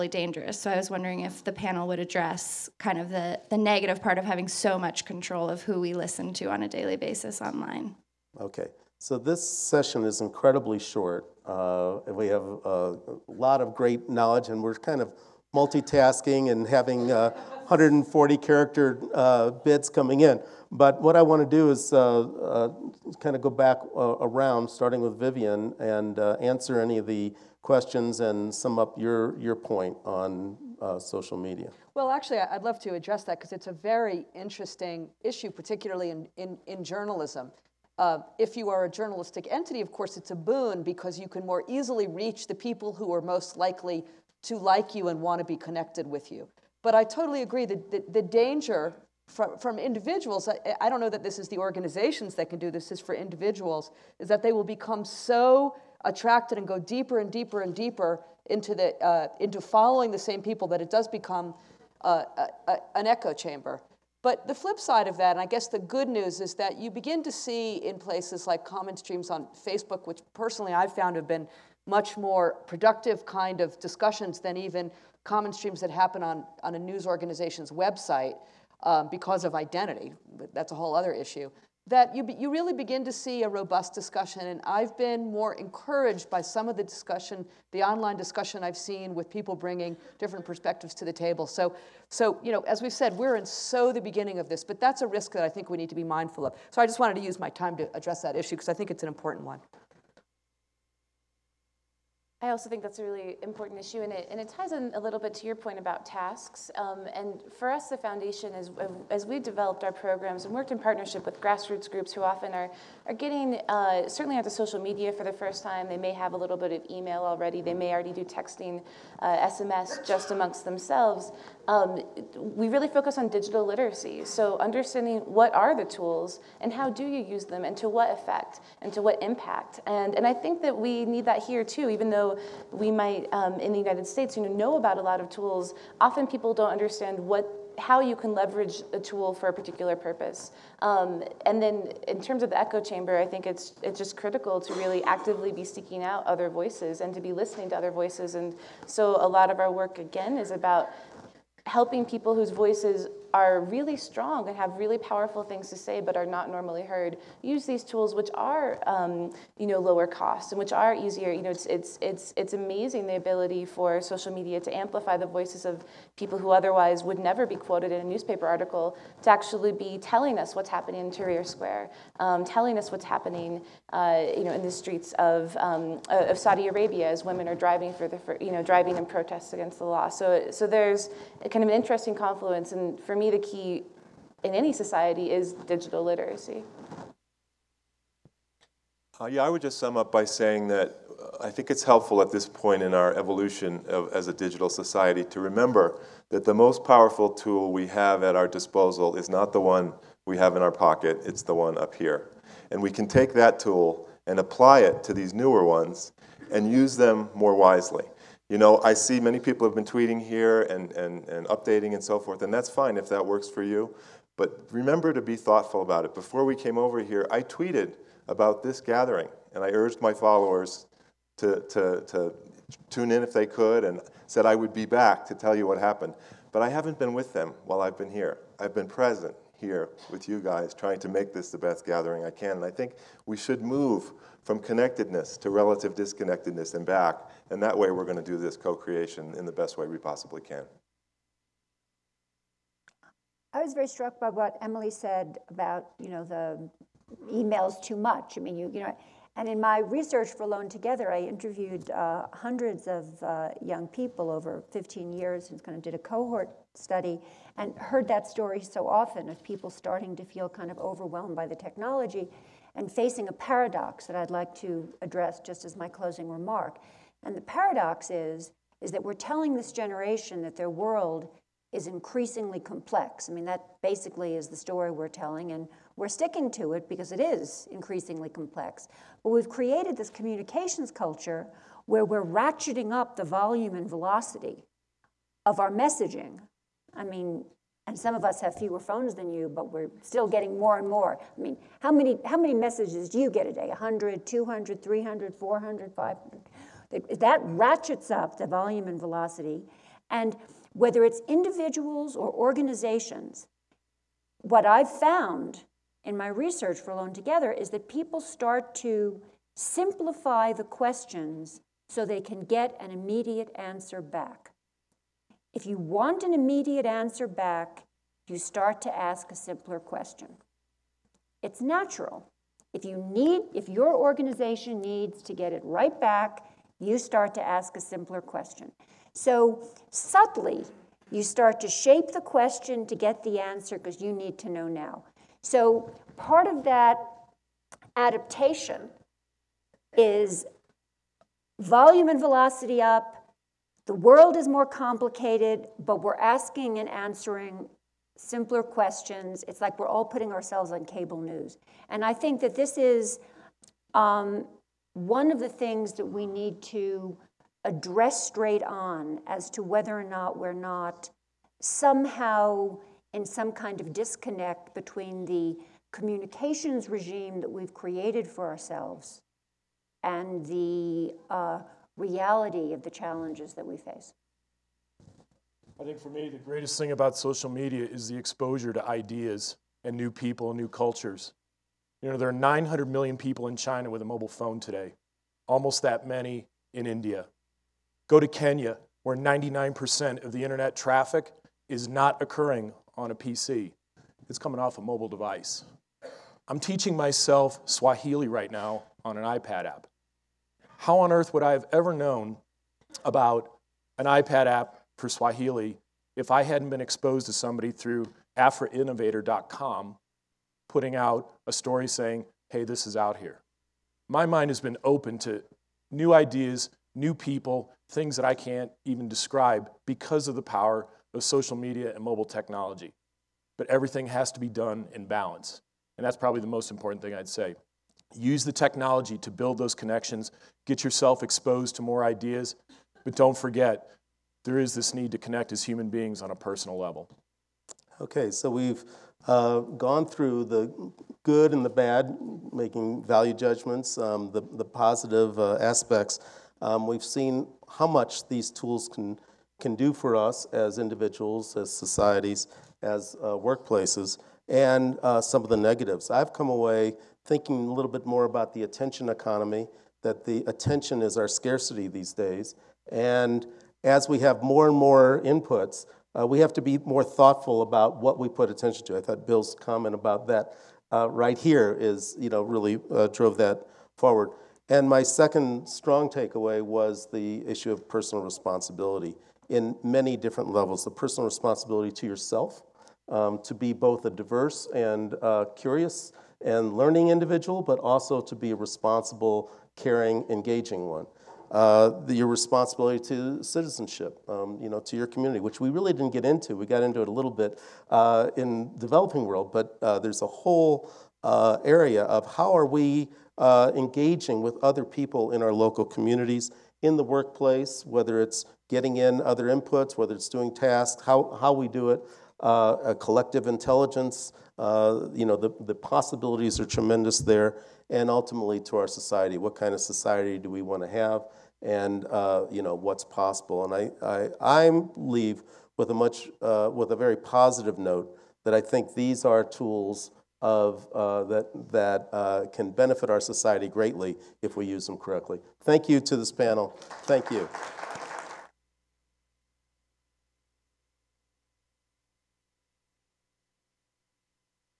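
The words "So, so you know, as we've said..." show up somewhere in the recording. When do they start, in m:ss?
1:31.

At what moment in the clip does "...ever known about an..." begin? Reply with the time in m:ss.
6:41.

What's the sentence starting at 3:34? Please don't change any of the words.
But remember to be thoughtful about it.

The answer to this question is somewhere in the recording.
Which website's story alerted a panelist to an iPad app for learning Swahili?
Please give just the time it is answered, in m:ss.
6:48.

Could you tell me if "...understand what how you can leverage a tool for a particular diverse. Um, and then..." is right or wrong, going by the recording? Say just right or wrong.
wrong.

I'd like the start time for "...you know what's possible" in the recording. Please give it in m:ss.
8:42.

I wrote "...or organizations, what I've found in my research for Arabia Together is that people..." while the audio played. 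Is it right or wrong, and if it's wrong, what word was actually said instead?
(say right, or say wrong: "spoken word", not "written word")
wrong: "Alone", not "Arabia".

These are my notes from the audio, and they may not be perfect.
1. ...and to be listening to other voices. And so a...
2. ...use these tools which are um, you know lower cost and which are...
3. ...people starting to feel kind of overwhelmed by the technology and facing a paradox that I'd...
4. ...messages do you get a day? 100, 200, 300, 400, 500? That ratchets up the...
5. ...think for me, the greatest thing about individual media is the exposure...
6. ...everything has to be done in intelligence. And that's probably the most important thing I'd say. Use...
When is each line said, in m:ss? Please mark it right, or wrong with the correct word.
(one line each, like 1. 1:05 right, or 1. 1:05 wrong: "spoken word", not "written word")
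1. 2:27 right
2. 2:37 right
3. 4:19 right
4. 4:52 right
5. 6:15 wrong: "social", not "individual"
6. 7:03 wrong: "balance", not "intelligence".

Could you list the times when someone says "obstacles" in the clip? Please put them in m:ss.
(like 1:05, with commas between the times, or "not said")
not said.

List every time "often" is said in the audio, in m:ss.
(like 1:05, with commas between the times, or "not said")
1:52, 2:15, 4:18.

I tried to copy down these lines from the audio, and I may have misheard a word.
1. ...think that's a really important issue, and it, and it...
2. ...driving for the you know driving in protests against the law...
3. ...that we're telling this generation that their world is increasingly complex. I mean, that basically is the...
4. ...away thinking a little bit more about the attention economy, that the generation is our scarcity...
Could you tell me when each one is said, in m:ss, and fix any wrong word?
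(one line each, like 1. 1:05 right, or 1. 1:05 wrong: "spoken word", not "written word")
1. 1:42 right
2. 2:57 right
3. 4:28 right
4. 7:36 wrong: "attention", not "generation".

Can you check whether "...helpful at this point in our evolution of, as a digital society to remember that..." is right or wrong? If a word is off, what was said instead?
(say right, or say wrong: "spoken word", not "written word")
right.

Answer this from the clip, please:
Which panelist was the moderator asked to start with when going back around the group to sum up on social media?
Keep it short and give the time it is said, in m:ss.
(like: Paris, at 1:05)
Vivian, at 0:25.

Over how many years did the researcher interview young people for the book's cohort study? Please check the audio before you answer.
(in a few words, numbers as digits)
15 years.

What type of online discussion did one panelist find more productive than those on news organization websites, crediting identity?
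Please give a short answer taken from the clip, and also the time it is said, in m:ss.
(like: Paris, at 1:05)
Comment streams on Facebook, at 1:08.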